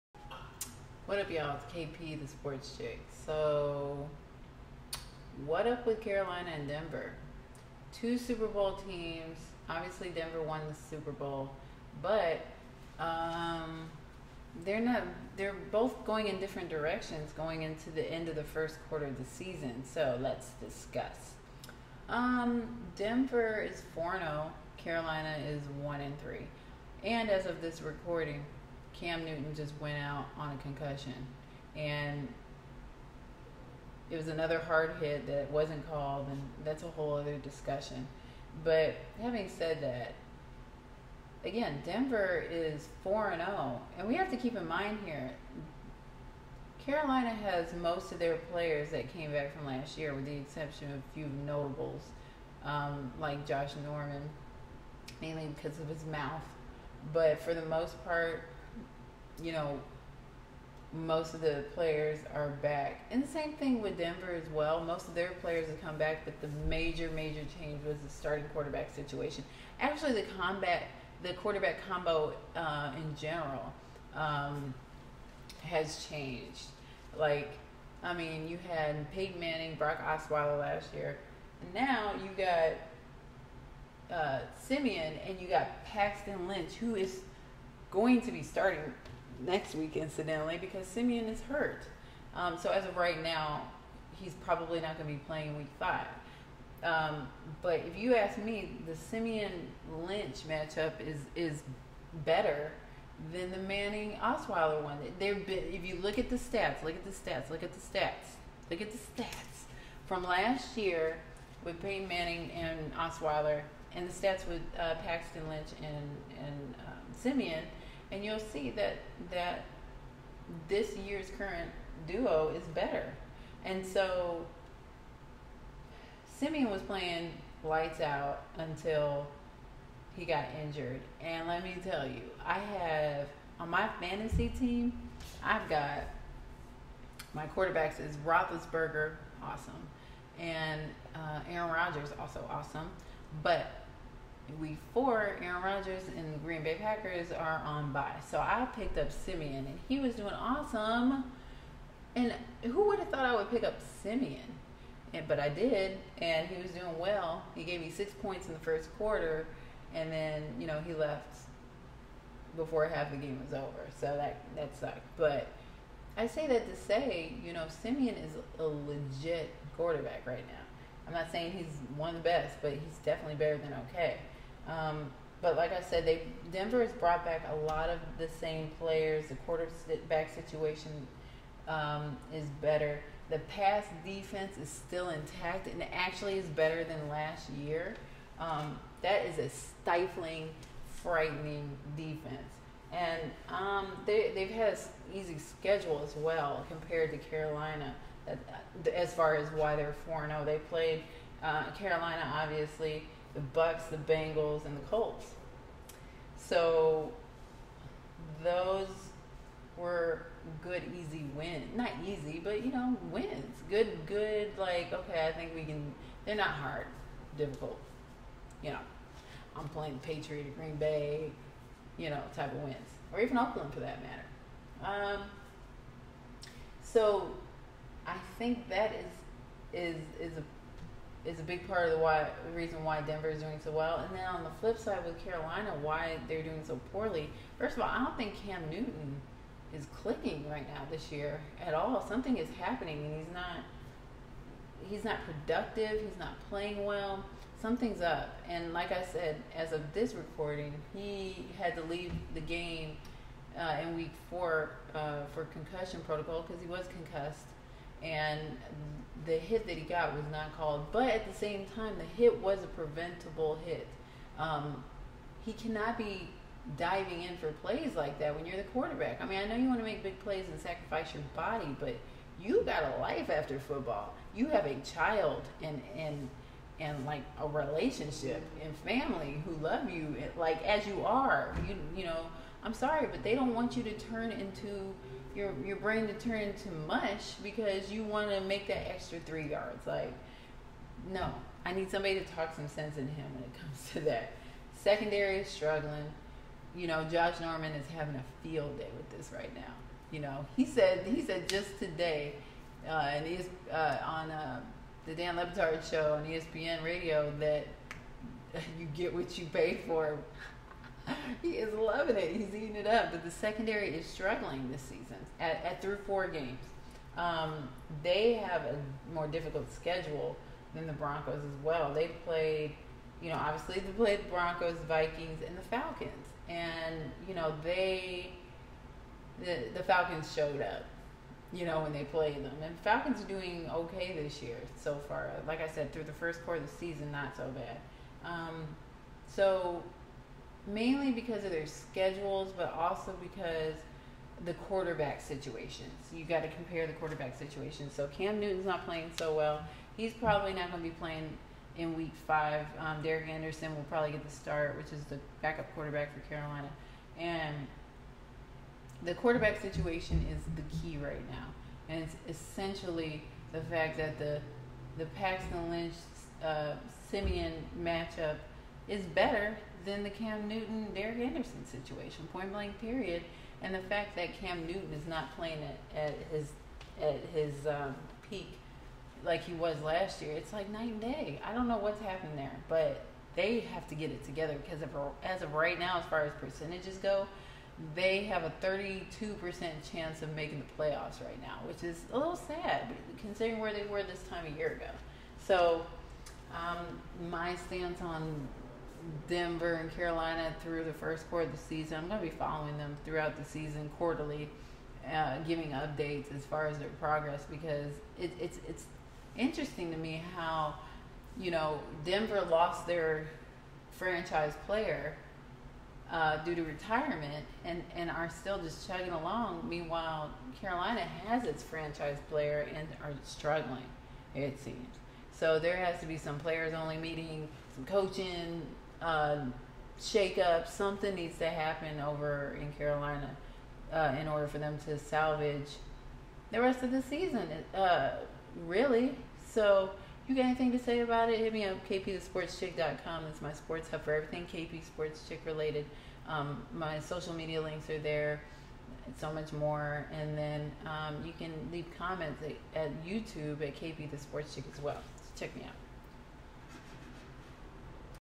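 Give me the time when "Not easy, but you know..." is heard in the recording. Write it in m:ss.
3:31.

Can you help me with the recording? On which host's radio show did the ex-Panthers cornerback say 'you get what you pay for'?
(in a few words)
Dan Le Batard.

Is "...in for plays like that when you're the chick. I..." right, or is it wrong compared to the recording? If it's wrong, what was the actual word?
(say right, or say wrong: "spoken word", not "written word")
wrong: "quarterback", not "chick".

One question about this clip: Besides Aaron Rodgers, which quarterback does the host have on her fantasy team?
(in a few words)
Roethlisberger.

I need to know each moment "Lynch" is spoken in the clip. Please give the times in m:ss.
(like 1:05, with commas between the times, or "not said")
1:26, 1:40, 1:55, 6:05.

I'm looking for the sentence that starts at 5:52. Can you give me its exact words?
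Um, Derek Anderson will probably get the start, which is the backup quarterback for Carolina.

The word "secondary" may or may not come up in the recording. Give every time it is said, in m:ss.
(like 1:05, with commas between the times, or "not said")
4:54, 5:13.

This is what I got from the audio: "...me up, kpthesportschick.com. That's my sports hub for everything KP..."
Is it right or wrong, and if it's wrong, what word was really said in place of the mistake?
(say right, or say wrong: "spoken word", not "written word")
right.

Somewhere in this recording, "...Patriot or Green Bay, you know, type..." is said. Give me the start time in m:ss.
3:40.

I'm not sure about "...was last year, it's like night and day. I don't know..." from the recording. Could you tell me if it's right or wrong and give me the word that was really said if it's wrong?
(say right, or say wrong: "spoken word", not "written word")
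right.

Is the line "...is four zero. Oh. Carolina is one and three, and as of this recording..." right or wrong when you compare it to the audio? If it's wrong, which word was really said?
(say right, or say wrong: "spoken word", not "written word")
right.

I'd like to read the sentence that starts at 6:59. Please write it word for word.
Meanwhile, Carolina has its franchise player and are struggling.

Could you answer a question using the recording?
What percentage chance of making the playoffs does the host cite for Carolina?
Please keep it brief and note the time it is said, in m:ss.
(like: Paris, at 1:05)
32%, at 6:28.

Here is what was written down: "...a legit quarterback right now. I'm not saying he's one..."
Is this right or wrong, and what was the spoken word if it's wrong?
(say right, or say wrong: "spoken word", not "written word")
right.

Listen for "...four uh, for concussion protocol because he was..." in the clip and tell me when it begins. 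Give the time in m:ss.
4:14.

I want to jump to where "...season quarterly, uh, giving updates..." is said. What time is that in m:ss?
6:43.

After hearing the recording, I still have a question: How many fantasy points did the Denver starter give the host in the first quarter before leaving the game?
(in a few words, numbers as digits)
6.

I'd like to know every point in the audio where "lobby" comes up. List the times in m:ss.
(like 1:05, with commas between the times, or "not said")
not said.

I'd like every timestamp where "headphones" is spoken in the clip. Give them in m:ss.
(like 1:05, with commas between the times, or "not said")
not said.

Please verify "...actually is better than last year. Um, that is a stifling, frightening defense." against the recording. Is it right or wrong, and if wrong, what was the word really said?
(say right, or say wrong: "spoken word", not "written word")
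right.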